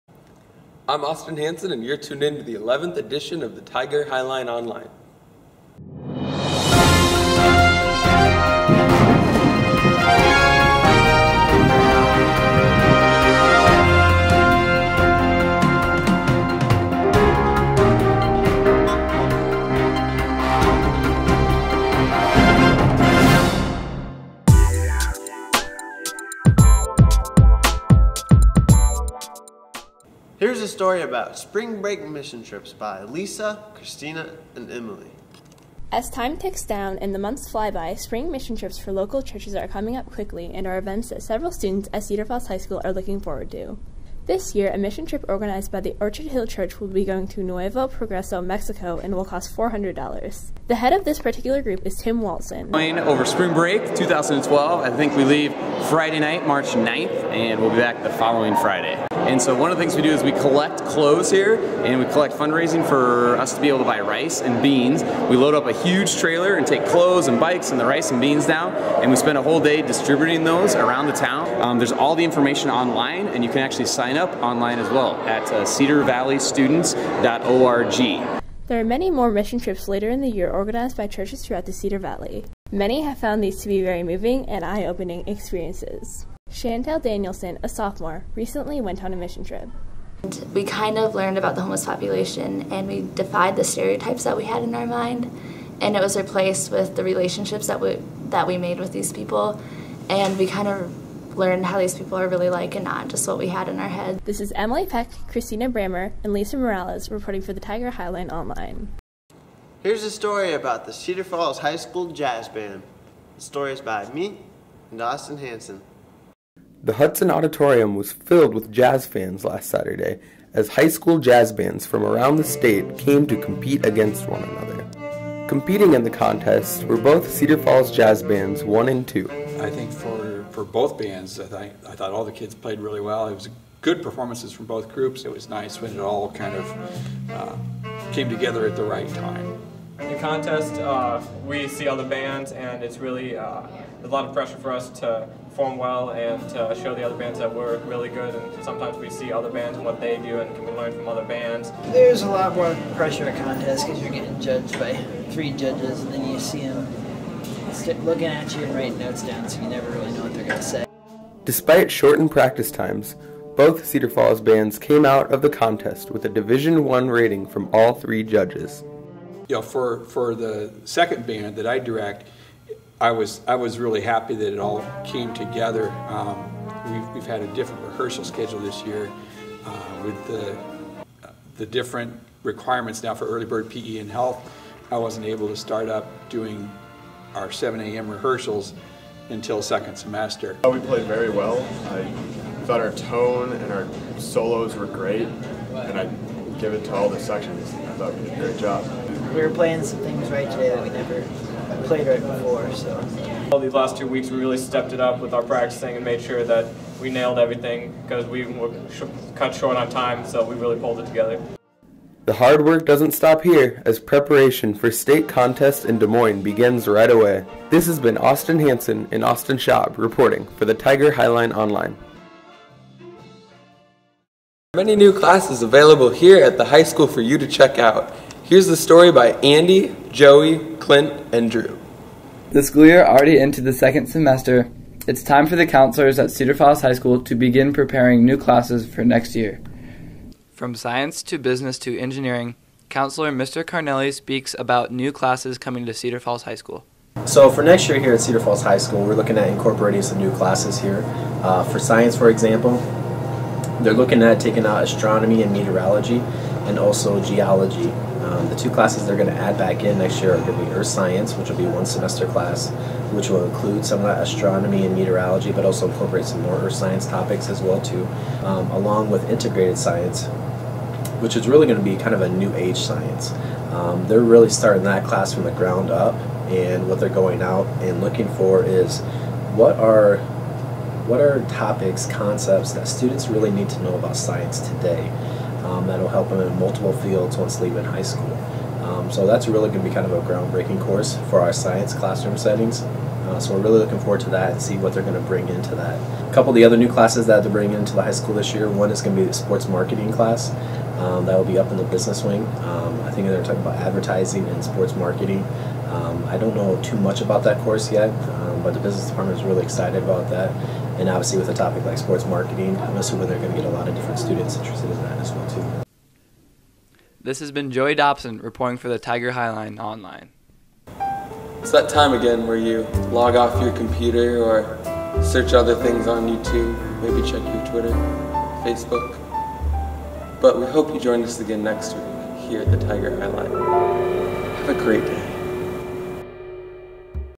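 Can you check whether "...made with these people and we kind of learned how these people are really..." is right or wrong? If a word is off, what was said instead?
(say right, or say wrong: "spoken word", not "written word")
right.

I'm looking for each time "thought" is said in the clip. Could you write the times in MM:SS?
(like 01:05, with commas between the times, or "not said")
02:11, 03:12, 03:17.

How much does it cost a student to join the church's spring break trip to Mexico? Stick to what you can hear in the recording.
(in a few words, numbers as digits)
$400.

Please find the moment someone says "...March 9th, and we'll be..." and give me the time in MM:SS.
00:56.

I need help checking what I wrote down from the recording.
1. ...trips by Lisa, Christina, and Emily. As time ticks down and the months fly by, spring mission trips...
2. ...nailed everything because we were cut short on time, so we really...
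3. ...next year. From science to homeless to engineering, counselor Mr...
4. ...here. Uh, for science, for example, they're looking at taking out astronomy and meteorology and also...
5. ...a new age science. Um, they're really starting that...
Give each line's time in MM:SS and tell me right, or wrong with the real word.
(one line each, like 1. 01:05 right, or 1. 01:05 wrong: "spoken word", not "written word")
1. 00:32 right
2. 03:27 right
3. 03:59 wrong: "business", not "homeless"
4. 04:10 right
5. 04:32 right.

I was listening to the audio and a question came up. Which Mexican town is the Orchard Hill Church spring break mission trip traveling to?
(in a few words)
Nuevo Progreso.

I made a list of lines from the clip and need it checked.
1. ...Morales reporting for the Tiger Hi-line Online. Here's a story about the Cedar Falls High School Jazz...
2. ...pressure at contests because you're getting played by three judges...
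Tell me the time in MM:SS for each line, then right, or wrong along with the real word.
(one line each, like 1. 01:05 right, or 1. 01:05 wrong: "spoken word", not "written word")
1. 01:46 right
2. 02:32 wrong: "judged", not "played".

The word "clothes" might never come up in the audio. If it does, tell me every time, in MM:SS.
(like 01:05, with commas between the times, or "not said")
01:00, 01:06.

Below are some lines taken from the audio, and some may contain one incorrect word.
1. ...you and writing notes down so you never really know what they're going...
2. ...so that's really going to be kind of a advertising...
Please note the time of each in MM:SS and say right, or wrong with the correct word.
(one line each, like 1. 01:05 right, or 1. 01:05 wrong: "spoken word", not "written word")
1. 02:38 right
2. 04:49 wrong: "groundbreaking", not "advertising".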